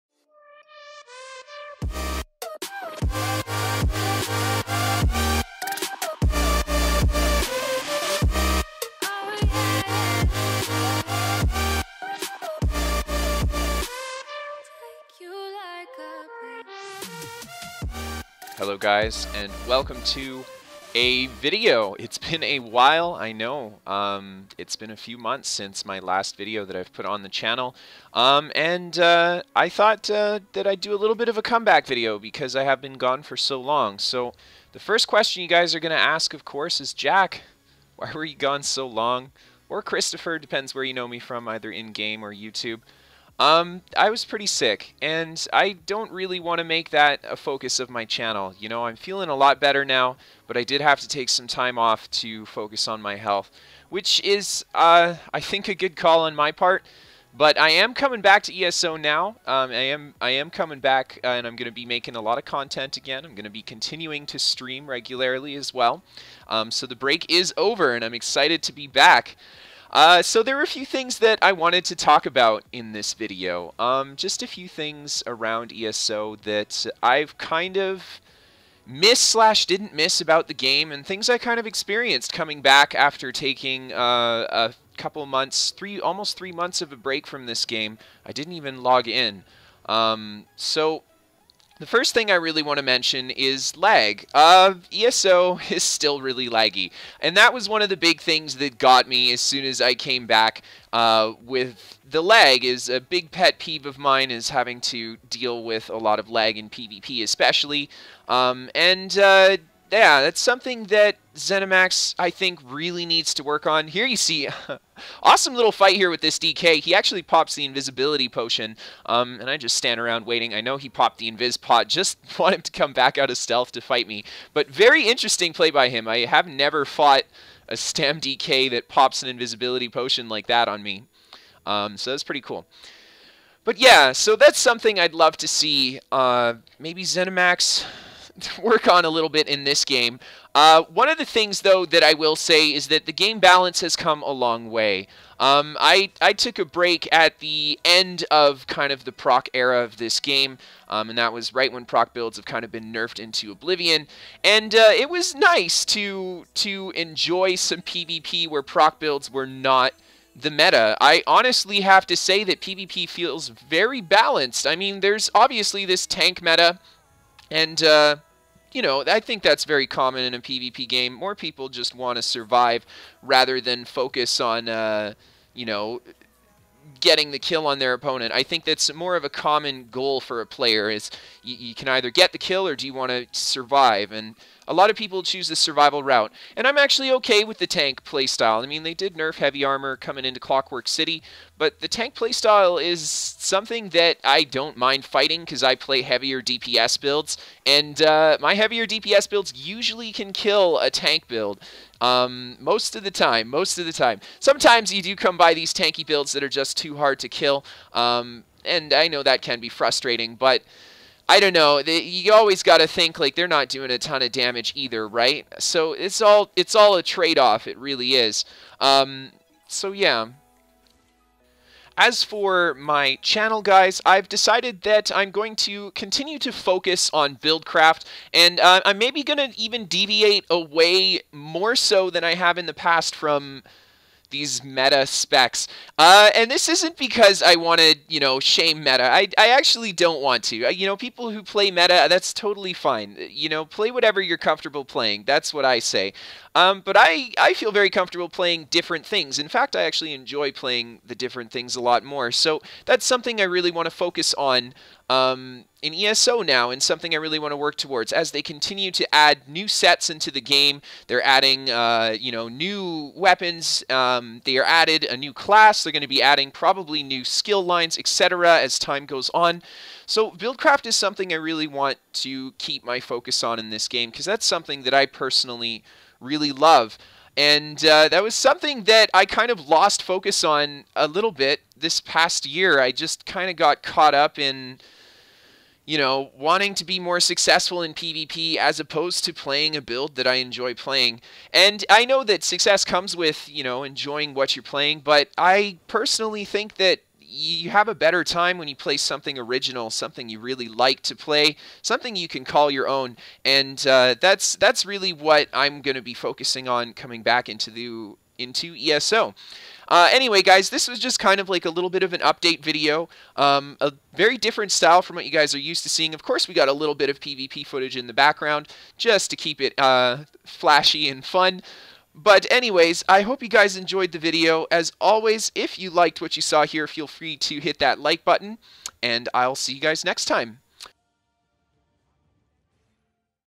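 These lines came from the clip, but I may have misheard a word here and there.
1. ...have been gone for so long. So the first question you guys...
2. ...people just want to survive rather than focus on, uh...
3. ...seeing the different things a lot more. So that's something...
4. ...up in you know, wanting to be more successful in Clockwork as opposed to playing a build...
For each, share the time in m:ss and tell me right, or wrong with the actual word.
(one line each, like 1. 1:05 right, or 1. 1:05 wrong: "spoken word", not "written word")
1. 0:32 right
2. 2:51 right
3. 4:10 wrong: "playing", not "seeing"
4. 4:44 wrong: "PvP", not "Clockwork".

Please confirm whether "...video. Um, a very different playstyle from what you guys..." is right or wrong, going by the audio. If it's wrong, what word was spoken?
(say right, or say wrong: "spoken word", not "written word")
wrong: "style", not "playstyle".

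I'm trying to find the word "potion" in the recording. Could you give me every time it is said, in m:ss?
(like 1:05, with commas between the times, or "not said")
1:58, 2:09.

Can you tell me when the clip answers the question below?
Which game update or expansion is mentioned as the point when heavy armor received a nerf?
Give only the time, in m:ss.
3:10.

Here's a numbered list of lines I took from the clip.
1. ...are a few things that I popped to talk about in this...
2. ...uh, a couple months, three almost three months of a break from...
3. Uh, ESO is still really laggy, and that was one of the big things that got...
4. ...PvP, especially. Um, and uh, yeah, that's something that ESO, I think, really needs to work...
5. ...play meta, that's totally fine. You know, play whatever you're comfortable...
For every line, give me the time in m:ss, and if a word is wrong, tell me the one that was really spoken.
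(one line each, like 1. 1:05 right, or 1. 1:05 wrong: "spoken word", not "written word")
1. 1:10 wrong: "wanted", not "popped"
2. 1:23 right
3. 1:34 right
4. 1:46 wrong: "Zenimax", not "ESO"
5. 4:01 right.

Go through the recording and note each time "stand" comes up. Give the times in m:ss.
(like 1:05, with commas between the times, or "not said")
1:59.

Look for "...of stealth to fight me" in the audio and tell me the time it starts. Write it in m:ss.
2:03.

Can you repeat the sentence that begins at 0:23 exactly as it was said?
Um, it's been a few months since my last video that I've put on the channel.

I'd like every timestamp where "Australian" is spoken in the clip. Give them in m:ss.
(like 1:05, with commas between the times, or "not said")
not said.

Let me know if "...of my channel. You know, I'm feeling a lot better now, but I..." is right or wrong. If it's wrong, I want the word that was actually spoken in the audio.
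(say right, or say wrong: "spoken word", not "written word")
right.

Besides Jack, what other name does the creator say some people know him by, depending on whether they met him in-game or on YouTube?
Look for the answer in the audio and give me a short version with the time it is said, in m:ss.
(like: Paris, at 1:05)
Kristofer, at 0:39.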